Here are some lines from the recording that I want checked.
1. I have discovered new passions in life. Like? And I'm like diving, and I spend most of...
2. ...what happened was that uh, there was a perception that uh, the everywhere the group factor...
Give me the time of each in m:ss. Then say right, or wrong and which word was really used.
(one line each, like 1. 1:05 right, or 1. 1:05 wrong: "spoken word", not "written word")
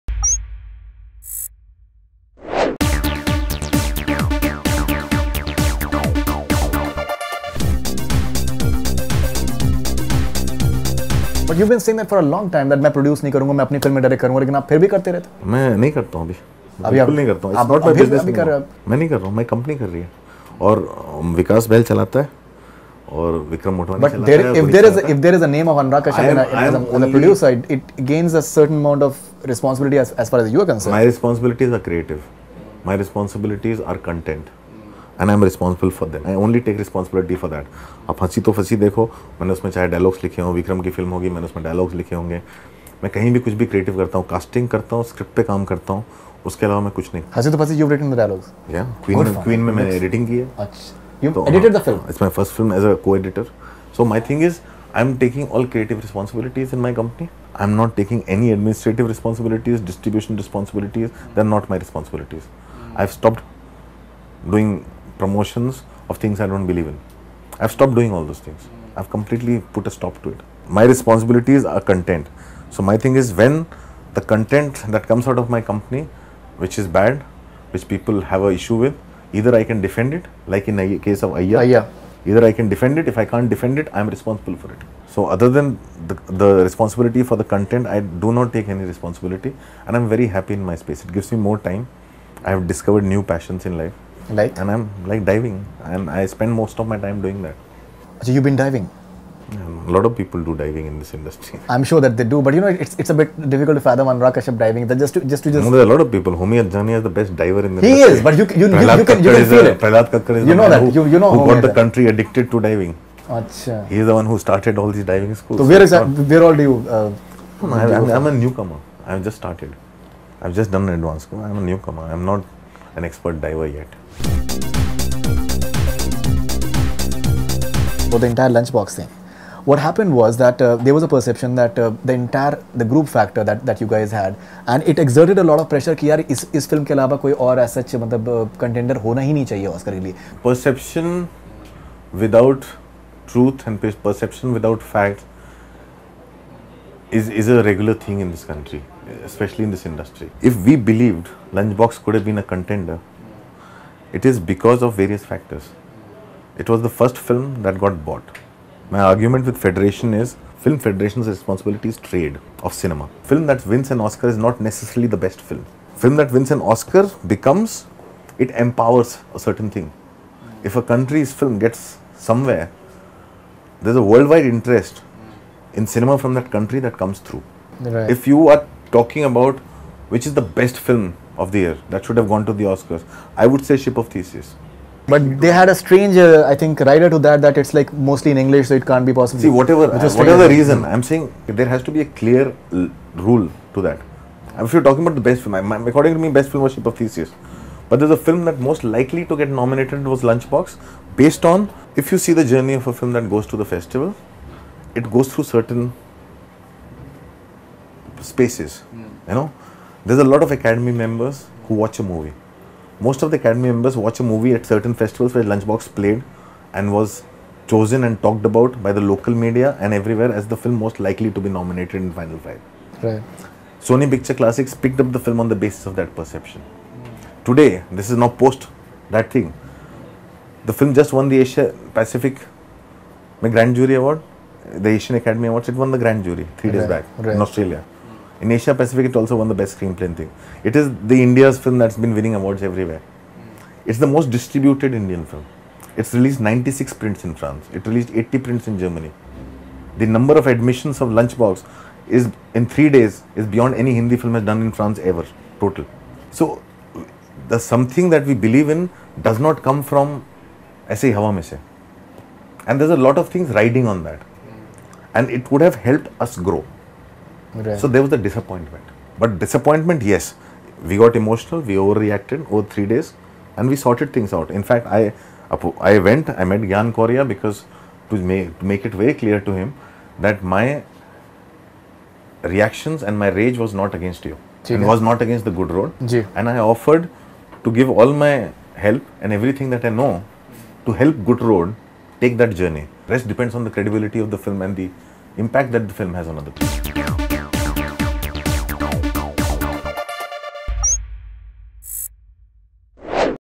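1. 1:32 right
2. 2:09 wrong: "entire", not "everywhere".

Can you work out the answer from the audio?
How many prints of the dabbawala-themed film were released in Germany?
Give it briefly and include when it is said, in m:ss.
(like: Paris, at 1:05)
80, at 4:08.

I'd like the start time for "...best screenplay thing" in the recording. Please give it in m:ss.
3:59.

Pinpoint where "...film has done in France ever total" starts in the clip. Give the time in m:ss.
4:14.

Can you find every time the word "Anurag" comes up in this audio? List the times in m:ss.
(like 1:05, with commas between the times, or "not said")
0:25, 1:44.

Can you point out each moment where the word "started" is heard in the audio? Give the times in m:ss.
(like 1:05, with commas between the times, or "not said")
1:54, 1:59.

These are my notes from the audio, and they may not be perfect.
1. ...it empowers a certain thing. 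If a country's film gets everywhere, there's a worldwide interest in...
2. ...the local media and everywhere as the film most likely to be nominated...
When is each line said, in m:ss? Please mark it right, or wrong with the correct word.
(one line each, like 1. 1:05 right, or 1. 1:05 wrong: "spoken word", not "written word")
1. 2:48 wrong: "somewhere", not "everywhere"
2. 3:38 right.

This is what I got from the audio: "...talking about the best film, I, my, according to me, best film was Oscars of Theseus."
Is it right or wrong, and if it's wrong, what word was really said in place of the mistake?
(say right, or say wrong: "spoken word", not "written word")
wrong: "Ship", not "Oscars".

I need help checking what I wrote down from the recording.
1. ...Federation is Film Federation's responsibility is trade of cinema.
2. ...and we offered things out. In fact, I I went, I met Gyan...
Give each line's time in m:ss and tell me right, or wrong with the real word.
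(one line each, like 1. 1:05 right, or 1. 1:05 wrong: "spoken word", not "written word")
1. 2:39 right
2. 4:33 wrong: "sorted", not "offered".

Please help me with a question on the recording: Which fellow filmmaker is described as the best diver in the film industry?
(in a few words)
Homi Adajania.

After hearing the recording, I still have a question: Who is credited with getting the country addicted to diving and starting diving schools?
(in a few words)
Prahlad Kakkar.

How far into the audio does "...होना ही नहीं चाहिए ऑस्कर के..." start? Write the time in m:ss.
2:19.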